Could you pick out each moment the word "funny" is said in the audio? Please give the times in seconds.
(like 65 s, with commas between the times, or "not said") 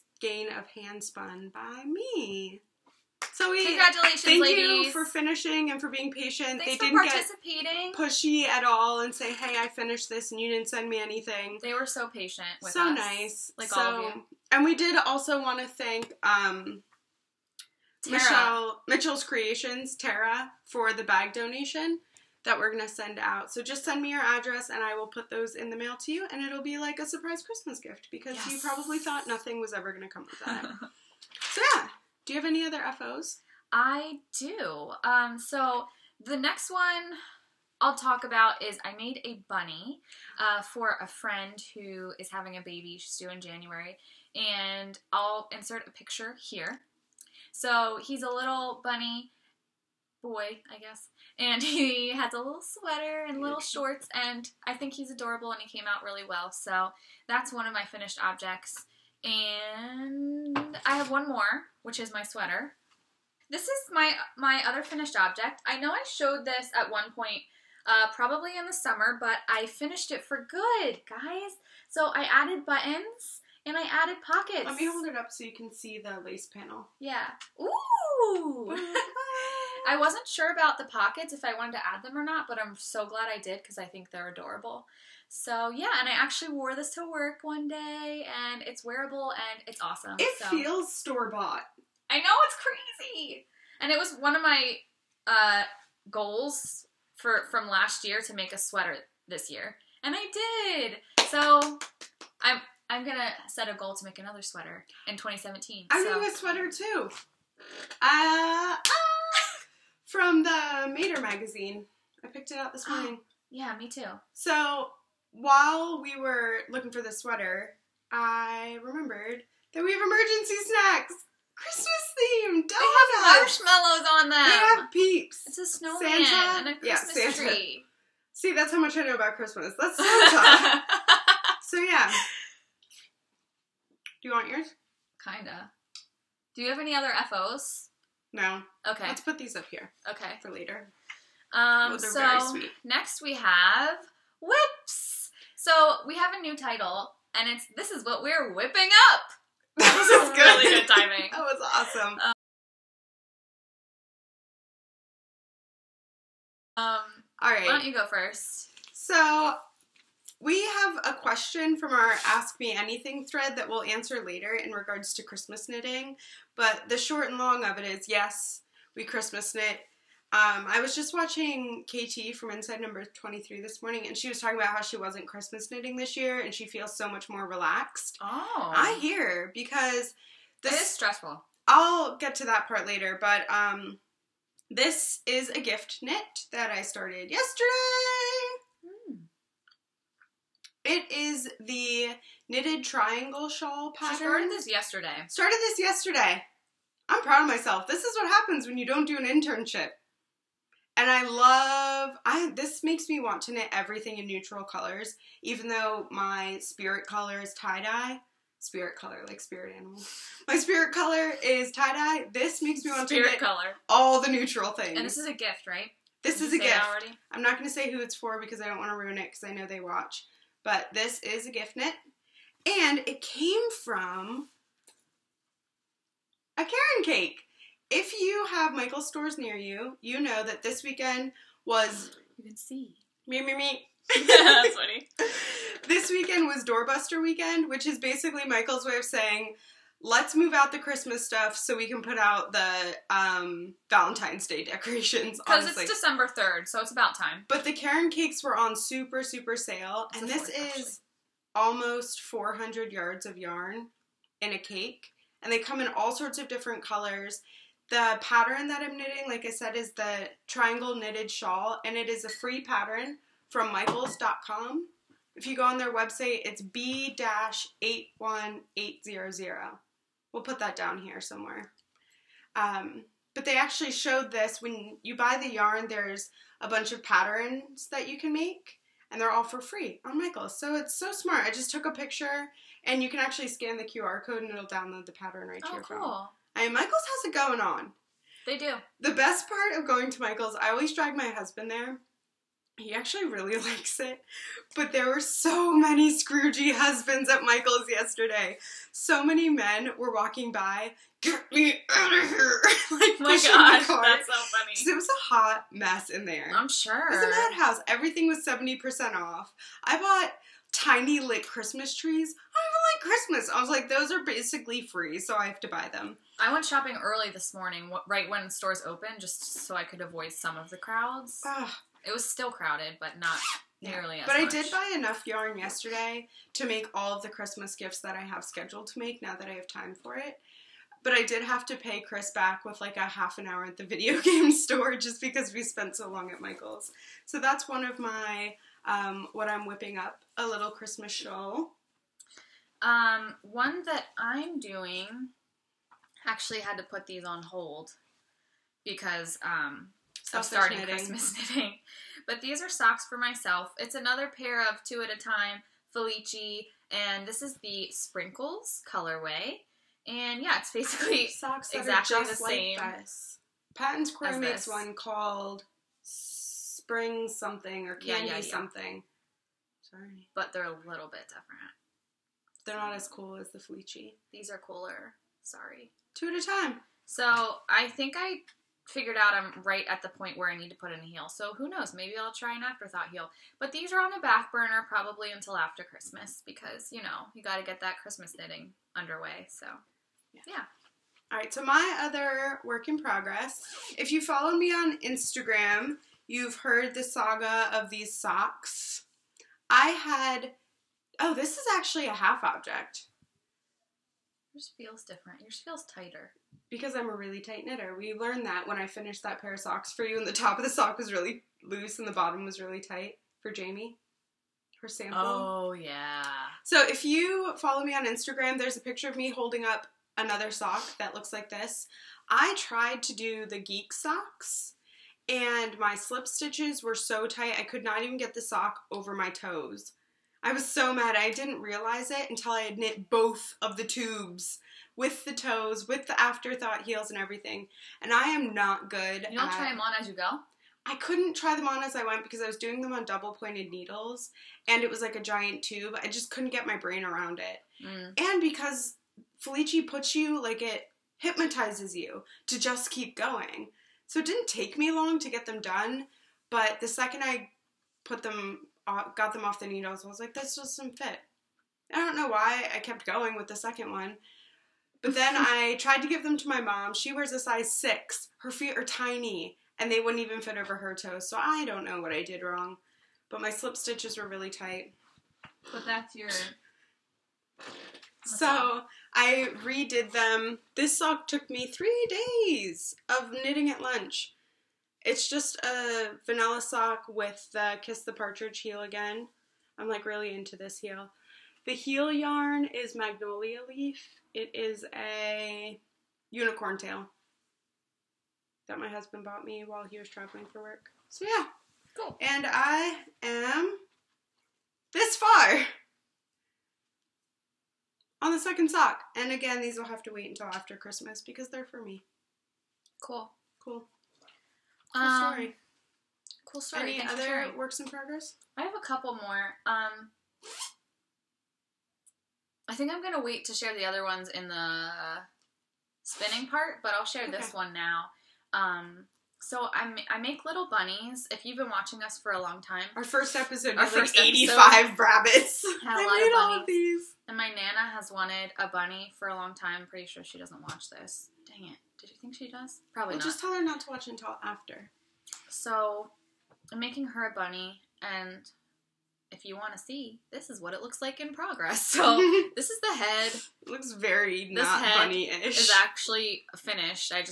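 234 s, 304 s.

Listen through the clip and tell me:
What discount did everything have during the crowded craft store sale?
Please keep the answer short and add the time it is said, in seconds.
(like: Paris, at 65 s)
70%, at 308 s.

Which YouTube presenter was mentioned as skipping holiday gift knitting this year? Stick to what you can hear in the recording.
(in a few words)
KT from Inside Number 23.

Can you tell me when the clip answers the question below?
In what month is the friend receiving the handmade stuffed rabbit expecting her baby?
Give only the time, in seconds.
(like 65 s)
43 s.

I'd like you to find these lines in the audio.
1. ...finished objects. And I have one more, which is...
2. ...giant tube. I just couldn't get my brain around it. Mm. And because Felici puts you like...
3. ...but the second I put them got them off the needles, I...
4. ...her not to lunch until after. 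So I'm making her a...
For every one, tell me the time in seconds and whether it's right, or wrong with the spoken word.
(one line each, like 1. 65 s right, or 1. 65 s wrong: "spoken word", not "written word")
1. 57 s right
2. 445 s right
3. 456 s right
4. 543 s wrong: "watch", not "lunch".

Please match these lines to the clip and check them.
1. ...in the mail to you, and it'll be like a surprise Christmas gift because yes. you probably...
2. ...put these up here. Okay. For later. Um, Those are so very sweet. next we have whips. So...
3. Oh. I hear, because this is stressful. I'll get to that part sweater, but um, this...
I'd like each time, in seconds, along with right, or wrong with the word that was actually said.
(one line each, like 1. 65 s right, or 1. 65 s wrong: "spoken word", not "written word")
1. 25 s right
2. 139 s right
3. 178 s wrong: "later", not "sweater".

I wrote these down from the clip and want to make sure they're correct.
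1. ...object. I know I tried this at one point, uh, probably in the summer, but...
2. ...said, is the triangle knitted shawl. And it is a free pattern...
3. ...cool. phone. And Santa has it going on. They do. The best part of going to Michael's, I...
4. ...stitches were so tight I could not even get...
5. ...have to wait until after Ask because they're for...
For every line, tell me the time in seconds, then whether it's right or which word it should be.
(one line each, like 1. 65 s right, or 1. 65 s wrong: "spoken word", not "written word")
1. 65 s wrong: "showed", not "tried"
2. 259 s right
3. 285 s wrong: "Michaels", not "Santa"
4. 426 s right
5. 509 s wrong: "Christmas", not "Ask".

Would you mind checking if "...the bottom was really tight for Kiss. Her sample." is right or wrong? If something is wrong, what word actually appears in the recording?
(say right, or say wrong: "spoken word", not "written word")
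wrong: "Jamie", not "Kiss".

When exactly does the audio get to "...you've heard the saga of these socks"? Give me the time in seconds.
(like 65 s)
396 s.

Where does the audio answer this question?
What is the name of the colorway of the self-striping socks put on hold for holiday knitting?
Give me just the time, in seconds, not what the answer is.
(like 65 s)
357 s.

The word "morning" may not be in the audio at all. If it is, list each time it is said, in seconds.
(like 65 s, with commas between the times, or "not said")
113 s, 173 s, 317 s.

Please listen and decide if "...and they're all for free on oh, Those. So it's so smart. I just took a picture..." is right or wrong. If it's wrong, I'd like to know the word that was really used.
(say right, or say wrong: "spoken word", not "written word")
wrong: "Michaels", not "Those".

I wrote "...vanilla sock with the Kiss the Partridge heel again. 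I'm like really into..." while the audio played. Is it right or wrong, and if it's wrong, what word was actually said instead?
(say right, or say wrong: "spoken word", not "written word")
right.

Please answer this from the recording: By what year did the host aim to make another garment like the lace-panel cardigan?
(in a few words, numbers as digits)
2017.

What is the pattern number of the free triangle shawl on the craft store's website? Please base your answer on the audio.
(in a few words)
B 81800.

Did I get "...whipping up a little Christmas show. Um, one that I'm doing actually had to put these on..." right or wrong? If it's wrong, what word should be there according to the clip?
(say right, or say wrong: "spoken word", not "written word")
right.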